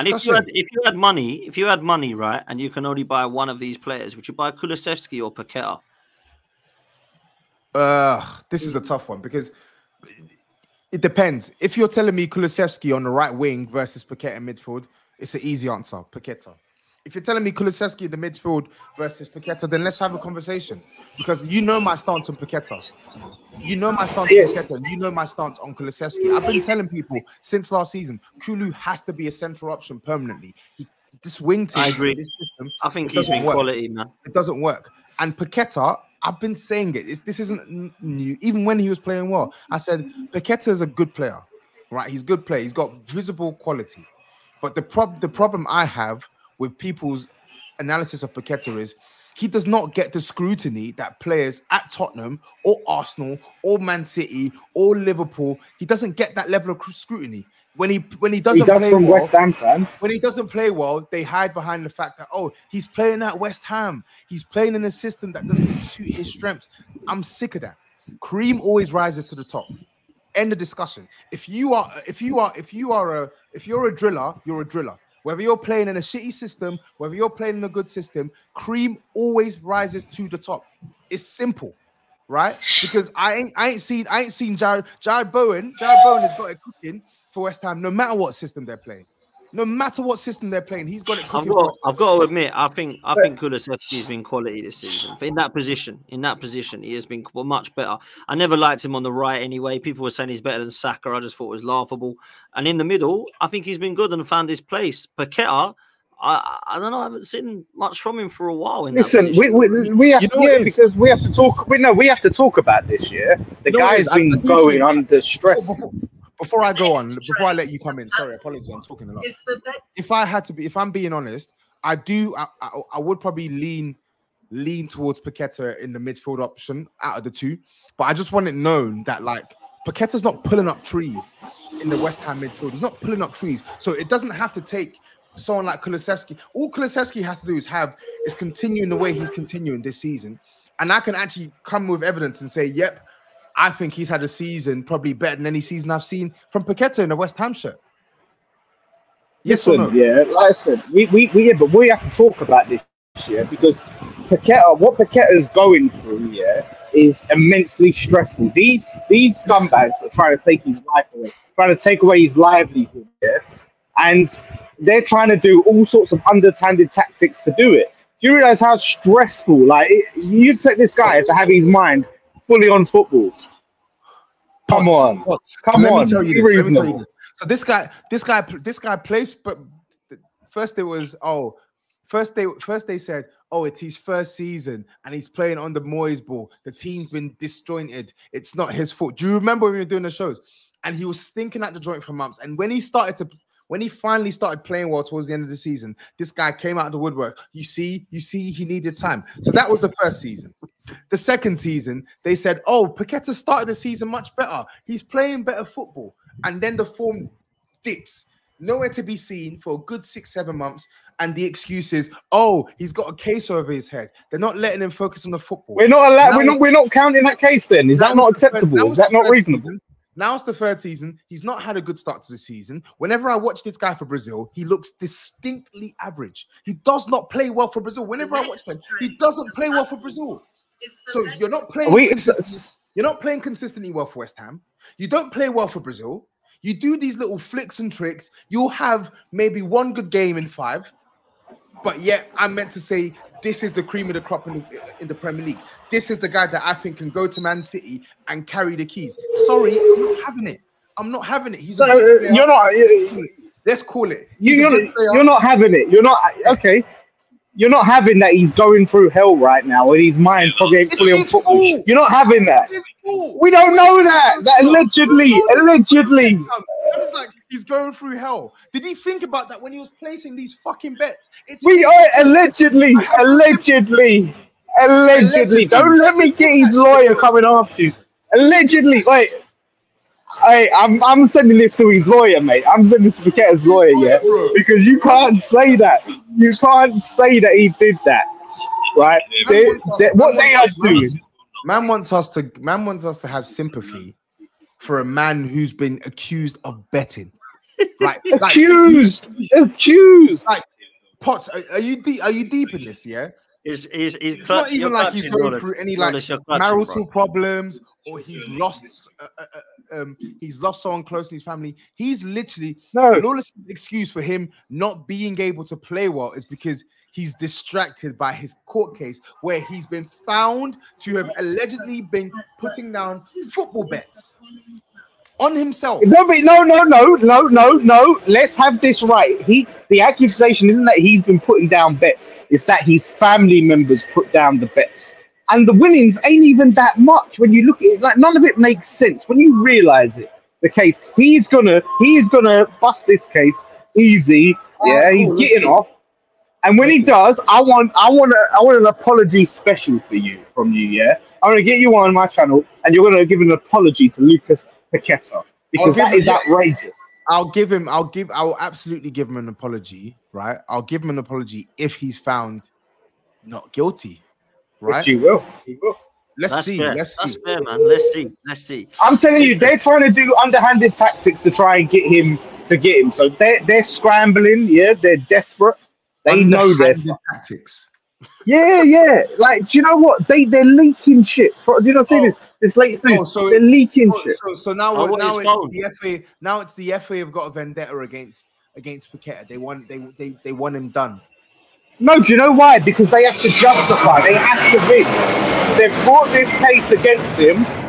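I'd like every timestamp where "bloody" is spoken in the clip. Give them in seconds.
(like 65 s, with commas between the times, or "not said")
not said.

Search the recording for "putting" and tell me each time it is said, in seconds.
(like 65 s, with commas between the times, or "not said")
322 s, 331 s.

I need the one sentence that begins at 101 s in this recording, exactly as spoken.
I just thought it was laughable.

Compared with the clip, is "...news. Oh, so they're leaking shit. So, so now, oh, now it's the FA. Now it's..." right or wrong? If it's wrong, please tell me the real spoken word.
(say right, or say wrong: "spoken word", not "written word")
right.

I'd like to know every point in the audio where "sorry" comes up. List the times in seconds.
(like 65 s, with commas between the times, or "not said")
118 s, 249 s.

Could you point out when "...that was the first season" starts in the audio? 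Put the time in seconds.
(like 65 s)
199 s.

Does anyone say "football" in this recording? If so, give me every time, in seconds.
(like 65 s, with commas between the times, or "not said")
172 s, 205 s, 215 s, 261 s, 323 s.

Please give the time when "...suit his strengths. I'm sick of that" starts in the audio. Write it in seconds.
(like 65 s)
65 s.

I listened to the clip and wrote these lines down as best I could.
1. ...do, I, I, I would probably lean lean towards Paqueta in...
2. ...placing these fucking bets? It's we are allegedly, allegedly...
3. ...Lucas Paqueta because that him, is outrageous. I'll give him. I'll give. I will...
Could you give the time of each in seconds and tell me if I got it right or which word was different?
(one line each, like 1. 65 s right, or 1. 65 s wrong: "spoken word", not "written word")
1. 121 s right
2. 270 s right
3. 354 s right.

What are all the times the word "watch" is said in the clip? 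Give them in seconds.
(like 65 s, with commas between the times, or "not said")
223 s, 228 s.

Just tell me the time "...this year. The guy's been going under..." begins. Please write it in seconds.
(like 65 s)
112 s.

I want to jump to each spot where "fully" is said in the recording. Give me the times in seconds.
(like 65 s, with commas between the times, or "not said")
172 s, 260 s.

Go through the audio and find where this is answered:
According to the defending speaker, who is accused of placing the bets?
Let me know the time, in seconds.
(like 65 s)
332 s.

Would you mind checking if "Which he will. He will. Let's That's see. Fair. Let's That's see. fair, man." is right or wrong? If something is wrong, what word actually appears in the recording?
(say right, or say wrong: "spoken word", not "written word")
right.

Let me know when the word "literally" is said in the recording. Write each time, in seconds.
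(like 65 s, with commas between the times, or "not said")
312 s.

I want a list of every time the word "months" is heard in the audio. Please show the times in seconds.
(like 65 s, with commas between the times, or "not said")
192 s, 210 s.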